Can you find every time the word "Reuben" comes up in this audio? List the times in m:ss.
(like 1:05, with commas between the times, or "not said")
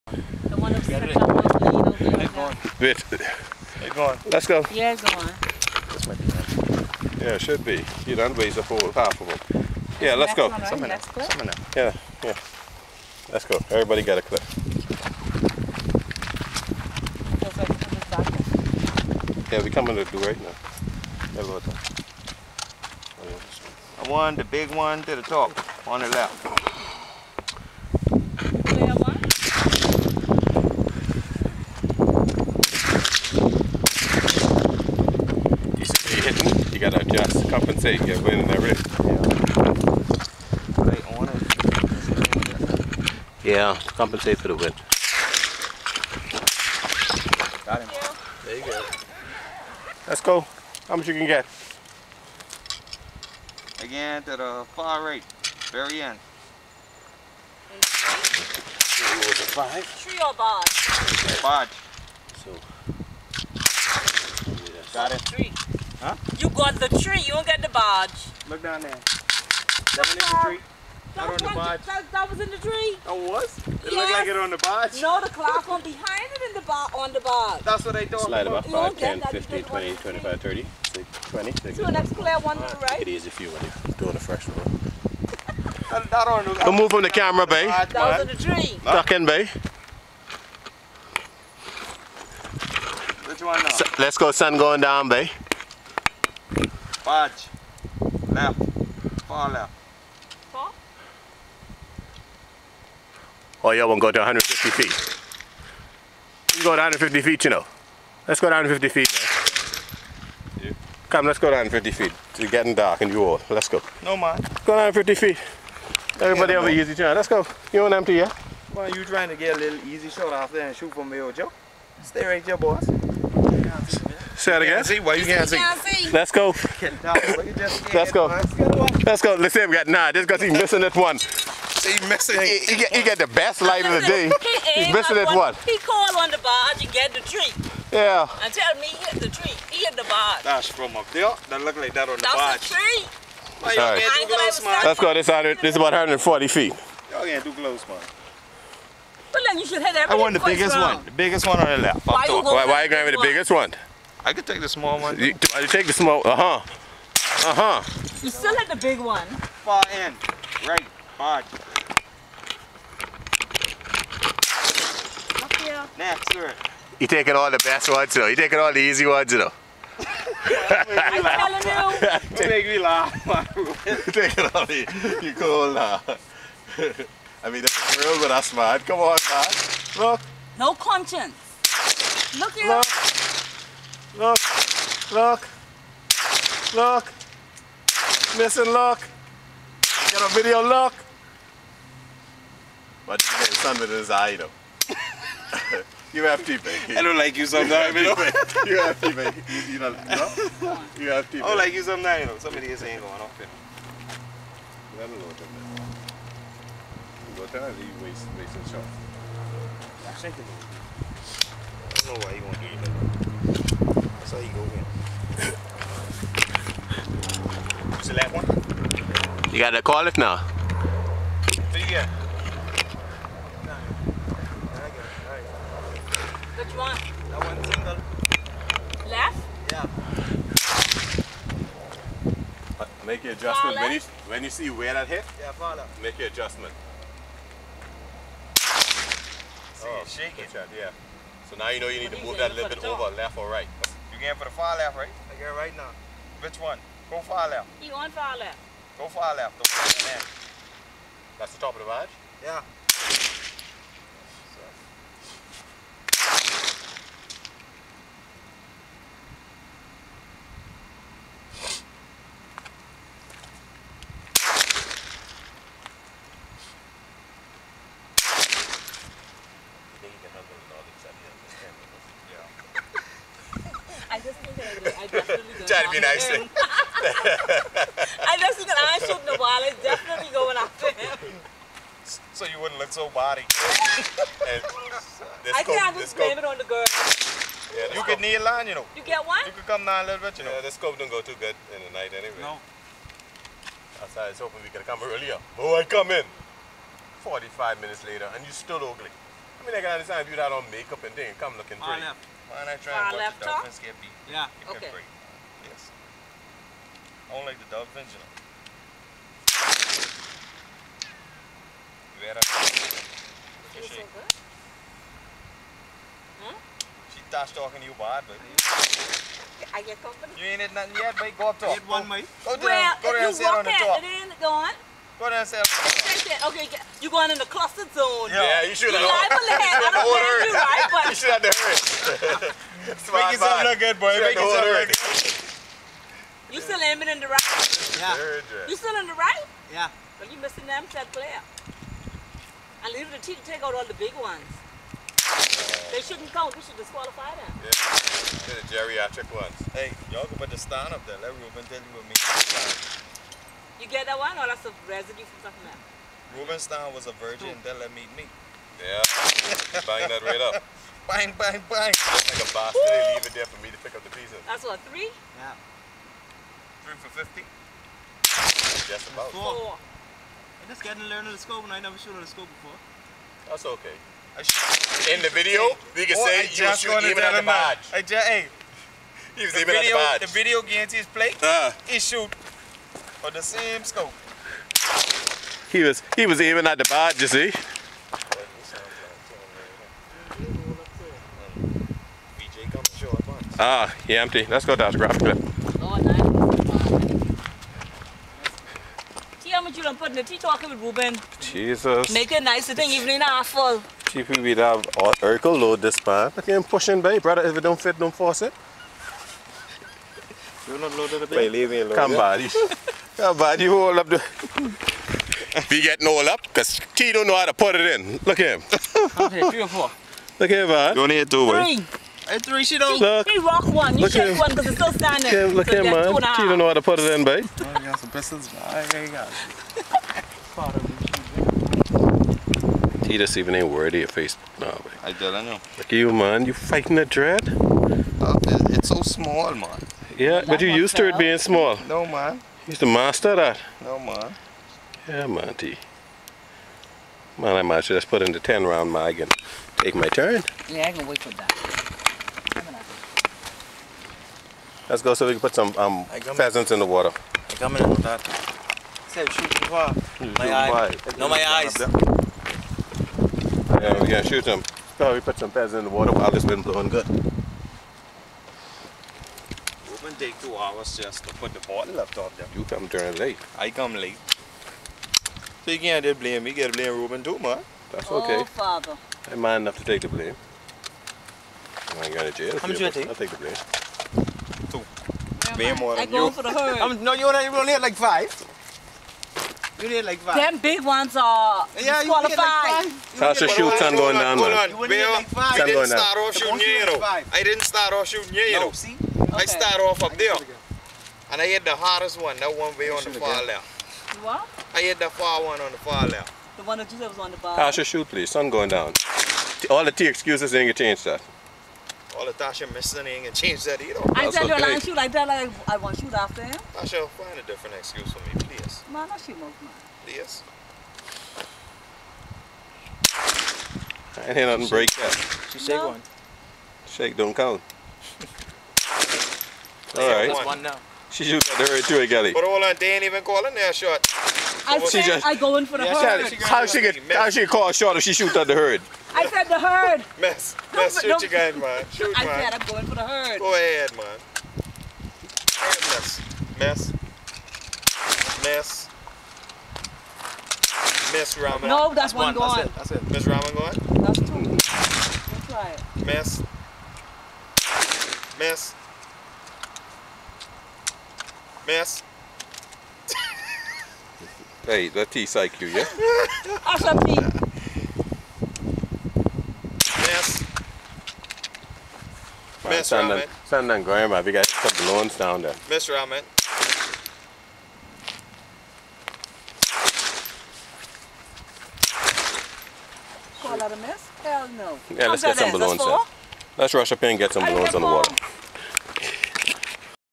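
5:51, 7:56.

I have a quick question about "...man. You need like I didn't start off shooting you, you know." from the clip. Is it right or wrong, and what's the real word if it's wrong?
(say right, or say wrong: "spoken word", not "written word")
right.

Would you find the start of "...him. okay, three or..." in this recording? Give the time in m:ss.
6:58.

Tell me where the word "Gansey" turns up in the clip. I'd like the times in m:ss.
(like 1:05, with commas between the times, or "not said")
2:05.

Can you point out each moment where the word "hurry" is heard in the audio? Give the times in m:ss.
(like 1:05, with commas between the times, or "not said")
5:31, 8:51.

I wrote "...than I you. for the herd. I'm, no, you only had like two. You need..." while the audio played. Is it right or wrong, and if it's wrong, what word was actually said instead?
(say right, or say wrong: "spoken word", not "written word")
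wrong: "five", not "two".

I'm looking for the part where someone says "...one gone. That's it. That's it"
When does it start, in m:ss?
9:12.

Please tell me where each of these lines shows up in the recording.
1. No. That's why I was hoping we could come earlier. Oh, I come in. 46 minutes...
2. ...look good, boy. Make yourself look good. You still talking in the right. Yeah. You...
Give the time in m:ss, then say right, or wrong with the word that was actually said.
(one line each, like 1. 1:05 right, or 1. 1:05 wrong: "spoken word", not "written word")
1. 4:52 wrong: "45", not "46"
2. 5:33 wrong: "aiming", not "talking".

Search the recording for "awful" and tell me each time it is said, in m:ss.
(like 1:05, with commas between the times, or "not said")
6:43.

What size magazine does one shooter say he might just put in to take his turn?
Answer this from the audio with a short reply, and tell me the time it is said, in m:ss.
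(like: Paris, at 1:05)
10 round, at 7:28.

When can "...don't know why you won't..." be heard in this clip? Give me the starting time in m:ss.
3:32.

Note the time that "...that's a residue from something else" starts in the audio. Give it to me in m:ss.
5:54.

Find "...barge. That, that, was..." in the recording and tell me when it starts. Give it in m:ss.
1:11.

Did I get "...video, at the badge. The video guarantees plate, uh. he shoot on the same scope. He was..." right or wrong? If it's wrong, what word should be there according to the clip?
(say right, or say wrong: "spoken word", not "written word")
right.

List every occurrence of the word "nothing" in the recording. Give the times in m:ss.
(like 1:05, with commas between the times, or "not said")
5:20, 8:44.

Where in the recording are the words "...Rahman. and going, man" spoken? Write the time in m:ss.
9:33.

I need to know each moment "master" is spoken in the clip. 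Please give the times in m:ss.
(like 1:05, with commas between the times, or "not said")
7:22.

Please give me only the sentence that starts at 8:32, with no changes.
All the Tasha missing ain't gonna change that either.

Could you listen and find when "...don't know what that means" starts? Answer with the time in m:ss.
3:25.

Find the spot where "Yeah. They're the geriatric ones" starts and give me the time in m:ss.
5:47.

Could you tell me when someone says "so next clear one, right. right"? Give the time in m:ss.
1:21.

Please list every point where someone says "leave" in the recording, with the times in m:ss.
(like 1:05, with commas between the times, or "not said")
5:42, 6:03, 6:51.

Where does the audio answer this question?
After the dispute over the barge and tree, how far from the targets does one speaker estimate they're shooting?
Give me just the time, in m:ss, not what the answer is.
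2:25.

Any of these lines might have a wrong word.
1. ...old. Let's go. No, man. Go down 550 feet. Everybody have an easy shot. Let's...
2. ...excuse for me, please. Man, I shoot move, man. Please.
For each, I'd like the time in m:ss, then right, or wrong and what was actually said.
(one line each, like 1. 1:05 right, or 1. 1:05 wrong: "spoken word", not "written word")
1. 1:53 wrong: "150", not "550"
2. 8:37 right.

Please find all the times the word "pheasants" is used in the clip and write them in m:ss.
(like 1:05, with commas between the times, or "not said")
7:36, 7:45.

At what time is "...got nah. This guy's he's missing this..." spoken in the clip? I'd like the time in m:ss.
2:09.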